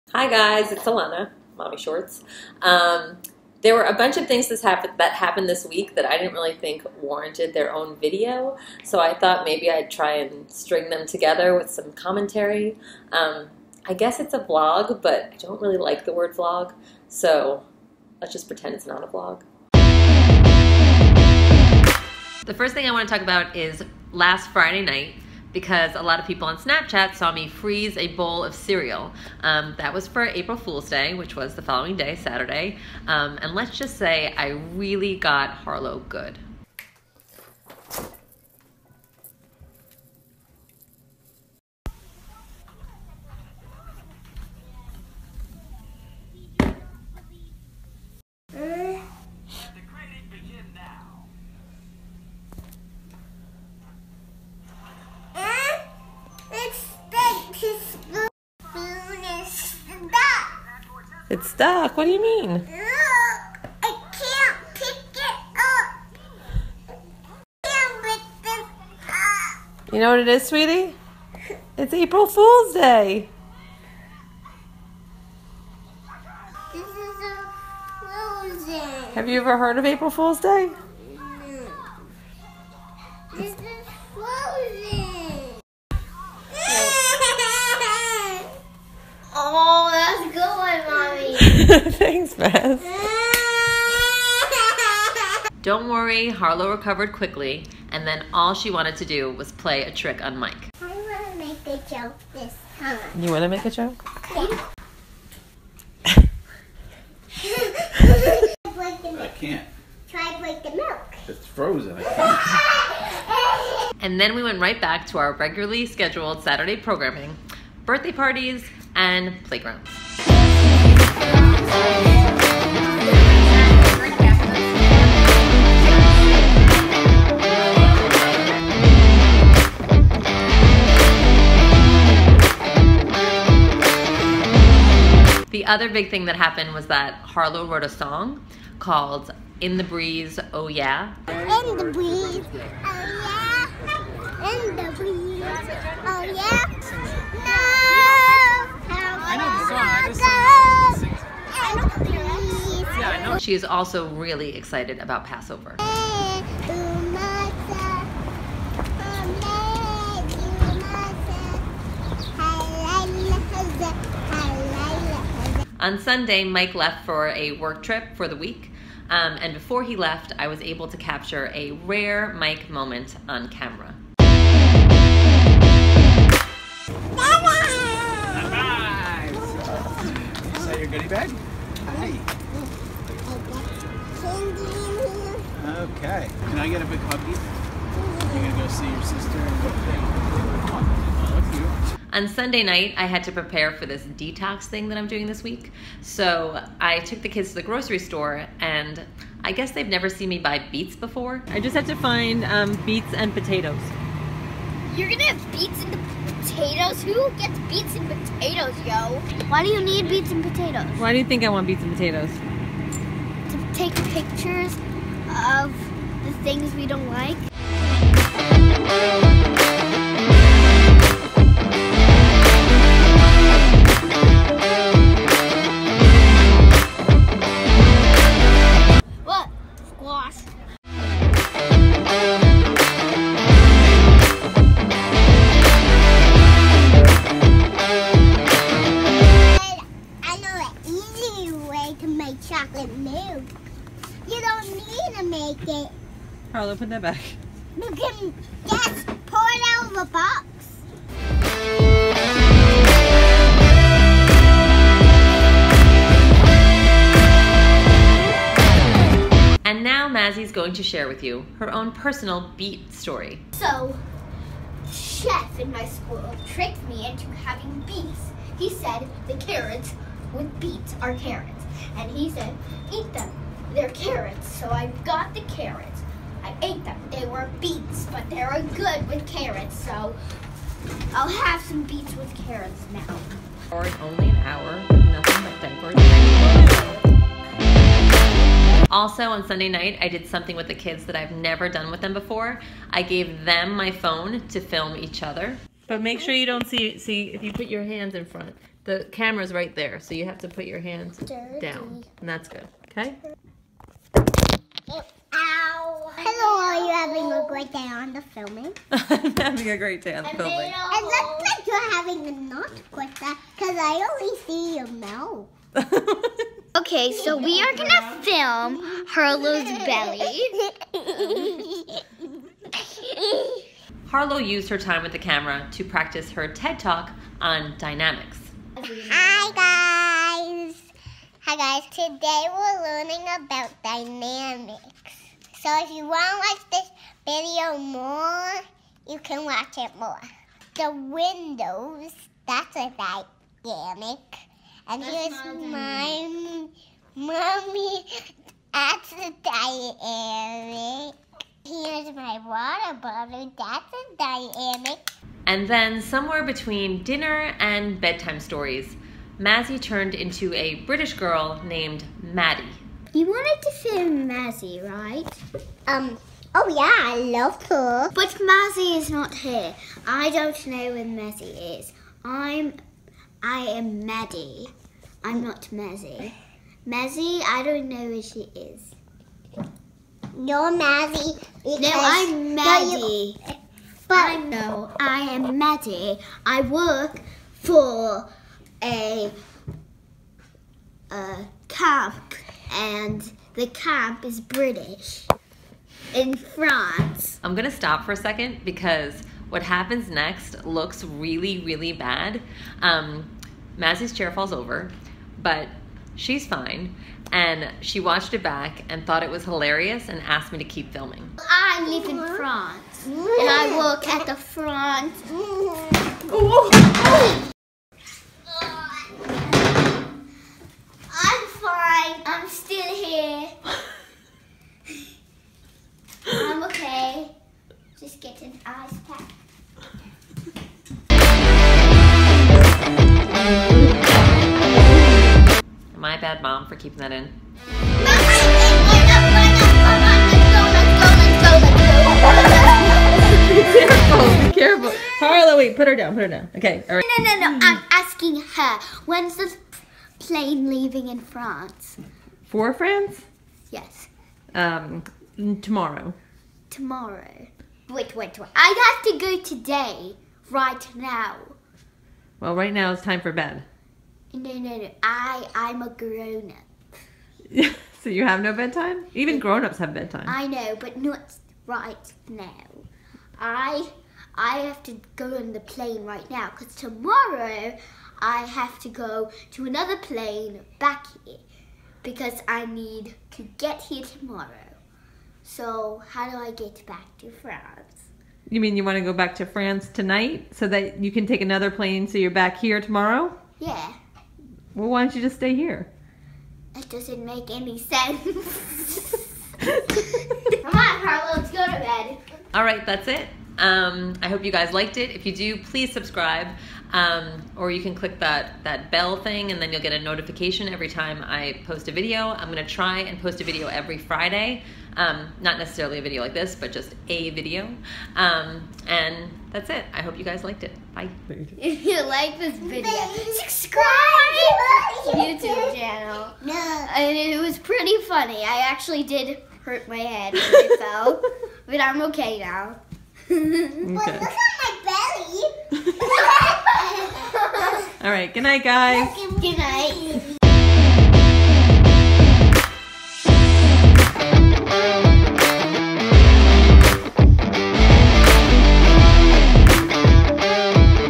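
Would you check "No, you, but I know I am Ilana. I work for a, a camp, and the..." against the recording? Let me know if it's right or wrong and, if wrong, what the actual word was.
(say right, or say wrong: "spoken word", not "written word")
wrong: "Maddie", not "Ilana".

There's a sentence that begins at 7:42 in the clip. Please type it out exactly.
Well, right now it's time for bed.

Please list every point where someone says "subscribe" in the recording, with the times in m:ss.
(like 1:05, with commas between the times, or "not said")
8:25, 8:43.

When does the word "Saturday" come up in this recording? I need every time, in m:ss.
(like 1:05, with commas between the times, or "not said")
0:32, 1:56.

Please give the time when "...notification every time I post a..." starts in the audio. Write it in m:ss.
8:30.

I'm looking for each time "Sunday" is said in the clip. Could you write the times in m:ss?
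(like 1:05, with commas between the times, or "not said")
2:45, 3:12, 4:49.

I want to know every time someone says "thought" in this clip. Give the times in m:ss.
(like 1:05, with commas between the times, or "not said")
0:09, 6:49.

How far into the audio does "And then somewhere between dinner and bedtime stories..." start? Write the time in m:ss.
5:55.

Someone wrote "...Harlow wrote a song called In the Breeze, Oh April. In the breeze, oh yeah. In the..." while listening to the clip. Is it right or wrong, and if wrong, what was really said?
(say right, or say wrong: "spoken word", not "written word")
wrong: "Yeah", not "April".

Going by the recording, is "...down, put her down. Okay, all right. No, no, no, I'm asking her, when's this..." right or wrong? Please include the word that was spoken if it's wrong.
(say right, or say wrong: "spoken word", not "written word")
right.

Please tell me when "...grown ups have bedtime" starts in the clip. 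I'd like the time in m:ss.
7:49.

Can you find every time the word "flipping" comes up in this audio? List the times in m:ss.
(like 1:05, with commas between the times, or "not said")
not said.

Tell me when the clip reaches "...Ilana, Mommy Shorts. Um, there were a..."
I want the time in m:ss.
0:00.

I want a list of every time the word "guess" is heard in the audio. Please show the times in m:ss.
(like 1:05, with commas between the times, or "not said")
0:13, 3:19.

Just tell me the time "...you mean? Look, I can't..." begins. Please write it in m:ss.
1:02.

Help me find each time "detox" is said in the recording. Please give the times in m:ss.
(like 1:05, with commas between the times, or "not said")
3:14.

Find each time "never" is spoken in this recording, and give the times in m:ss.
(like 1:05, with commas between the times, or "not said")
3:19, 4:51.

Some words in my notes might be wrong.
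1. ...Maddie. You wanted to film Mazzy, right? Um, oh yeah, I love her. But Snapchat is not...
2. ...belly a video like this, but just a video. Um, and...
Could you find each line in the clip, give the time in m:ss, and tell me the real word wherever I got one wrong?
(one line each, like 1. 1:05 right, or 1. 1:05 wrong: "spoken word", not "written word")
1. 6:02 wrong: "Mazzy", not "Snapchat"
2. 8:35 wrong: "necessarily", not "belly".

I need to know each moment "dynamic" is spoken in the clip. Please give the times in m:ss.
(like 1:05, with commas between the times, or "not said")
5:27, 5:33, 5:42, 5:49, 5:54.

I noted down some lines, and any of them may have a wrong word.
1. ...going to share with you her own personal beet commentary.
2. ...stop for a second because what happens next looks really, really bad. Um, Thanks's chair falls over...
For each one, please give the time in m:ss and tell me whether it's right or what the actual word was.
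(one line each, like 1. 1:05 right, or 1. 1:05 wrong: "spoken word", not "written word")
1. 4:20 wrong: "story", not "commentary"
2. 6:37 wrong: "Mazzy", not "Thanks".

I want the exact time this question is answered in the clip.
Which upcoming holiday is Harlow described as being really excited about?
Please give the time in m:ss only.
2:35.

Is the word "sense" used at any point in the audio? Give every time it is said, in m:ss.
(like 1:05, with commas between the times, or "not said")
8:17.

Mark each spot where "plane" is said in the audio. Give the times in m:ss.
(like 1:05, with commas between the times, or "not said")
7:30, 7:55, 7:59, 8:11.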